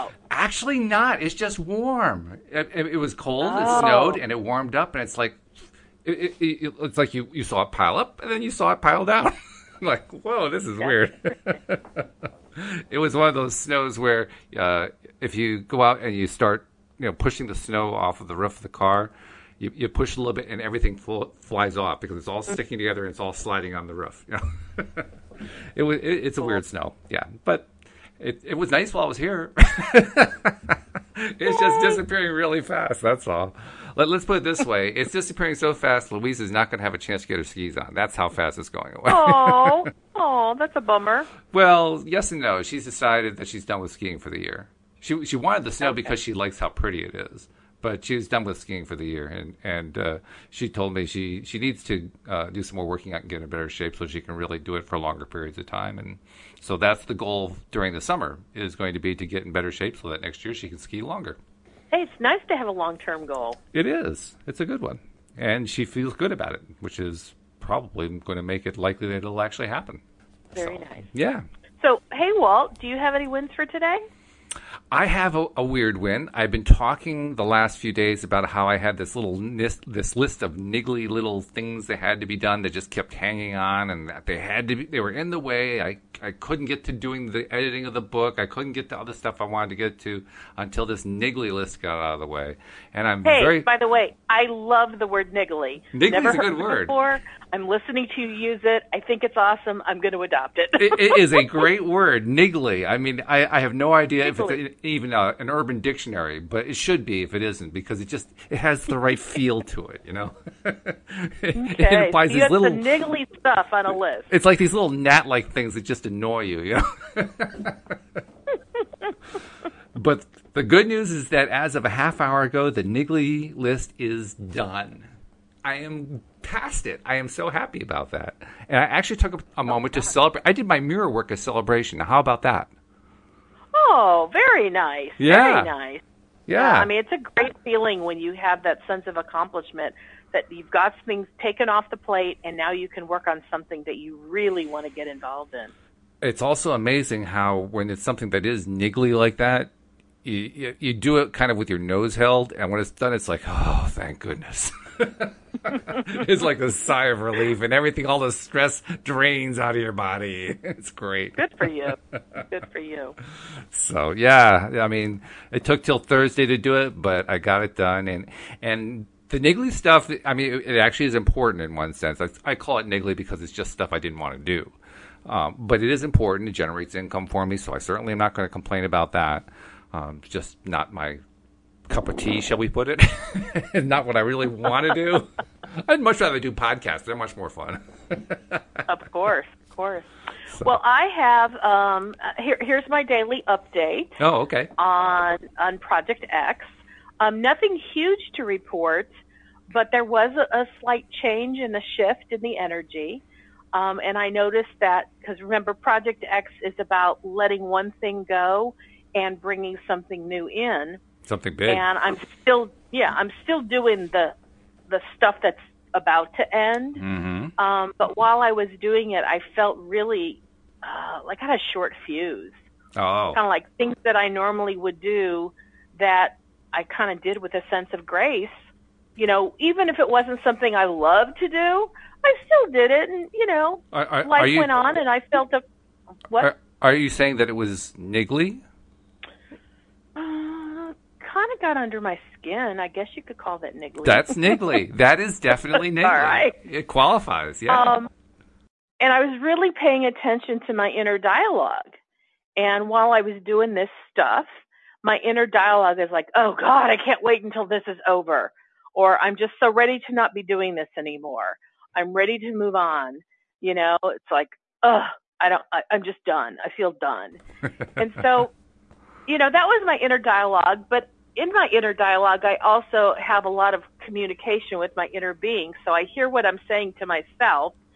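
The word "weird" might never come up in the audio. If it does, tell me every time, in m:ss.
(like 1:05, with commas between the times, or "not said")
0:10, 0:26, 1:15.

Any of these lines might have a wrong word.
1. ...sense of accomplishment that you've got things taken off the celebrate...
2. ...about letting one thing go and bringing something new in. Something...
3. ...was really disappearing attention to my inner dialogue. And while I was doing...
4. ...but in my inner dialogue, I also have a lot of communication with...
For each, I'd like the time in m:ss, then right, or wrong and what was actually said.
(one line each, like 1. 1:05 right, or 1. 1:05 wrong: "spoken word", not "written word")
1. 2:18 wrong: "plate", not "celebrate"
2. 3:26 right
3. 4:09 wrong: "paying", not "disappearing"
4. 4:30 right.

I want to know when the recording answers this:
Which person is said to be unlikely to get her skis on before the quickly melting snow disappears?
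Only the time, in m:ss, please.
0:36.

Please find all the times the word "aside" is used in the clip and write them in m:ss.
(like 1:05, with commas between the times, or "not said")
not said.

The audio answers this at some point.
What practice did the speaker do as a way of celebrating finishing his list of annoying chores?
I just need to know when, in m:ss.
2:10.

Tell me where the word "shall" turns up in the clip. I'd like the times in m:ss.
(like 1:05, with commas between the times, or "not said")
3:02.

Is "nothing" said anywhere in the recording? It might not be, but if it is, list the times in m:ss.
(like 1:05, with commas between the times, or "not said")
3:17.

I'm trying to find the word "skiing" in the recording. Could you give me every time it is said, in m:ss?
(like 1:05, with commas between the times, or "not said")
0:43, 0:48.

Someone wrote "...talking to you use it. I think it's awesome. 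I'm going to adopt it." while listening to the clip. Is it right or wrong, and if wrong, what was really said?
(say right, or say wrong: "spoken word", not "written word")
wrong: "listening", not "talking".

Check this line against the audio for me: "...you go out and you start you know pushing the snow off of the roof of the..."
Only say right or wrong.
right.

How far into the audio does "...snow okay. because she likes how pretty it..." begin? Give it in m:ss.
0:45.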